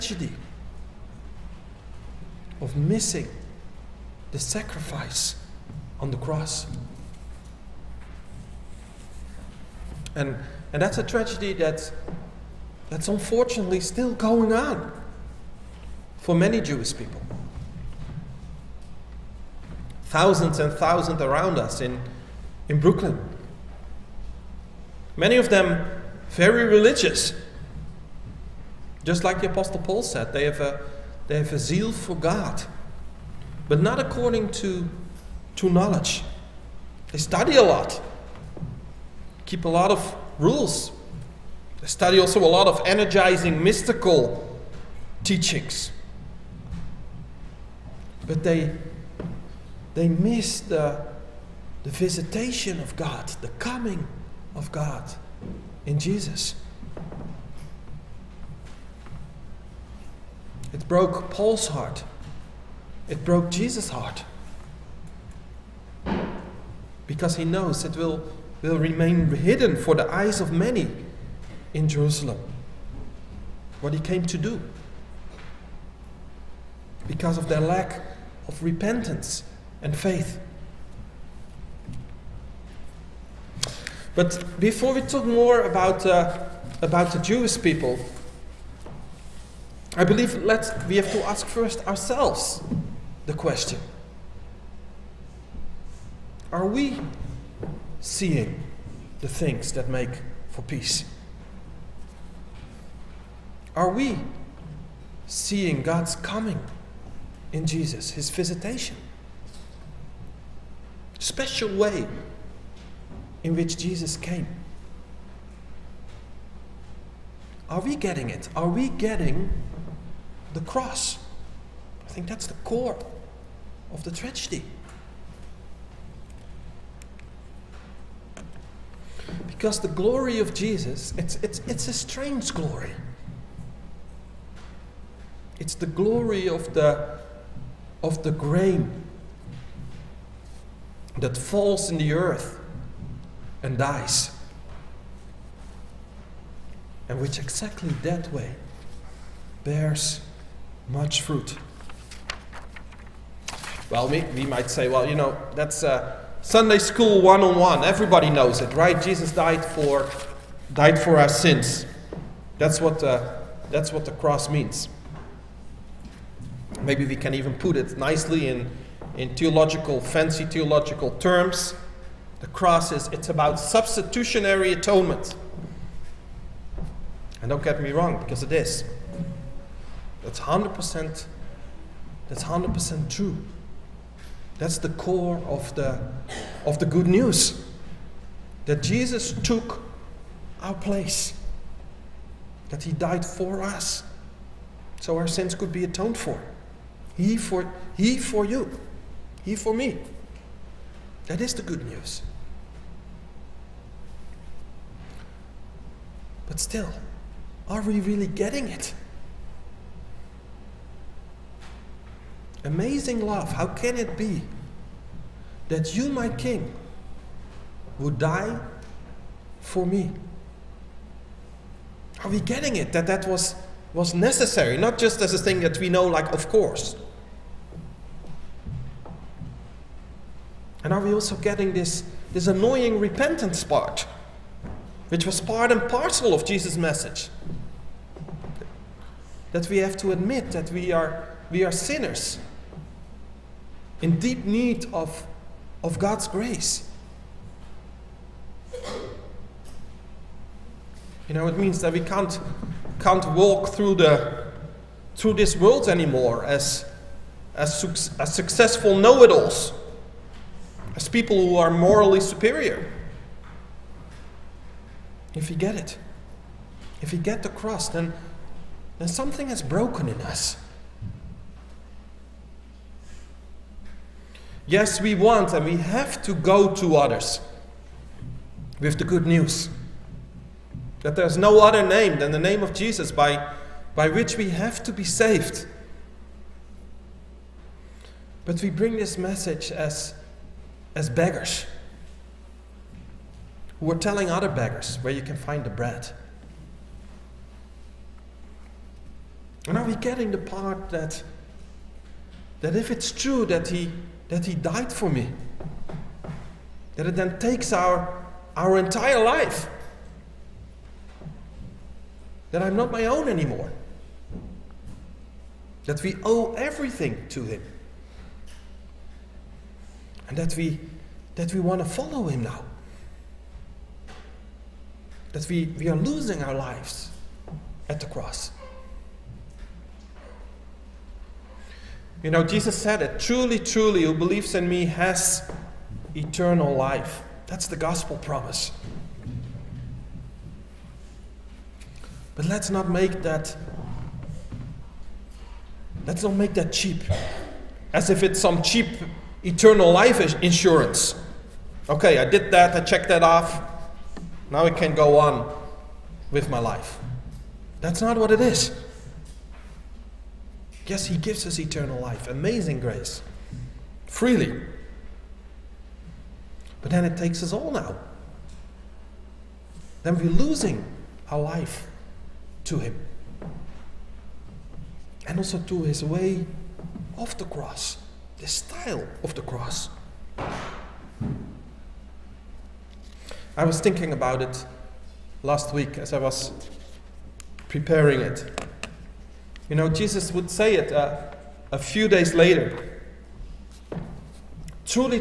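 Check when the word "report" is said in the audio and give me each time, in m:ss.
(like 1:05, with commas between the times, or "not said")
not said.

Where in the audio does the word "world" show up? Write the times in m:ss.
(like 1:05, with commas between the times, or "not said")
4:15.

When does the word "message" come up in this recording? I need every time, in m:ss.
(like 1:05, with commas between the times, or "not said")
3:56, 4:49.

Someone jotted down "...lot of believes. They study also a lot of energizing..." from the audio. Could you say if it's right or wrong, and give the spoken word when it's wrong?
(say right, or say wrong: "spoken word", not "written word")
wrong: "rules", not "believes".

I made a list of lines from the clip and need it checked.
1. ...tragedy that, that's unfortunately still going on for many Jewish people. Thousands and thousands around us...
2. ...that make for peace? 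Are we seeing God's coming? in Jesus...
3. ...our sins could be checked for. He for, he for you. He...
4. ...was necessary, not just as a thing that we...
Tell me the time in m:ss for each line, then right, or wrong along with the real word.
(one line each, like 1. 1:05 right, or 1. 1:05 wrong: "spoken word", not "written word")
1. 0:11 right
2. 1:39 right
3. 3:15 wrong: "atoned", not "checked"
4. 3:43 right.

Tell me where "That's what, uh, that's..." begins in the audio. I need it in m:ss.
2:42.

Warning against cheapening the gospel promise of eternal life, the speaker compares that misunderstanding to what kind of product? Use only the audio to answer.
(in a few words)
Eternal life insurance.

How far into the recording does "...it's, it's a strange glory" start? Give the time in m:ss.
2:11.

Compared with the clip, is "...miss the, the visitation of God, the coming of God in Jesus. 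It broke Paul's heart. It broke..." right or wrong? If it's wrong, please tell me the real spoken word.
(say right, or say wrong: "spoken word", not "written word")
right.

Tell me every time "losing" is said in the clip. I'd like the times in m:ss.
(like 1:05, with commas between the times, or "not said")
5:25, 6:10.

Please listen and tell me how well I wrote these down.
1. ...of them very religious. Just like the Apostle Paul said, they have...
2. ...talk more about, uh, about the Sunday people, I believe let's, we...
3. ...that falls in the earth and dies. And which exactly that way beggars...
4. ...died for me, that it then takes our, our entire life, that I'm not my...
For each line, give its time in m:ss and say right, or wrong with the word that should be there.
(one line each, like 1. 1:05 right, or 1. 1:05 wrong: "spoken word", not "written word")
1. 0:25 right
2. 1:25 wrong: "Jewish", not "Sunday"
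3. 2:21 wrong: "bears", not "beggars"
4. 5:04 right.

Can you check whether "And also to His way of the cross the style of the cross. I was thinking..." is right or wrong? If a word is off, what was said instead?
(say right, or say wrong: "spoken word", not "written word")
right.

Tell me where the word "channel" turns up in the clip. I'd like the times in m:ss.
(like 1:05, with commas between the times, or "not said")
not said.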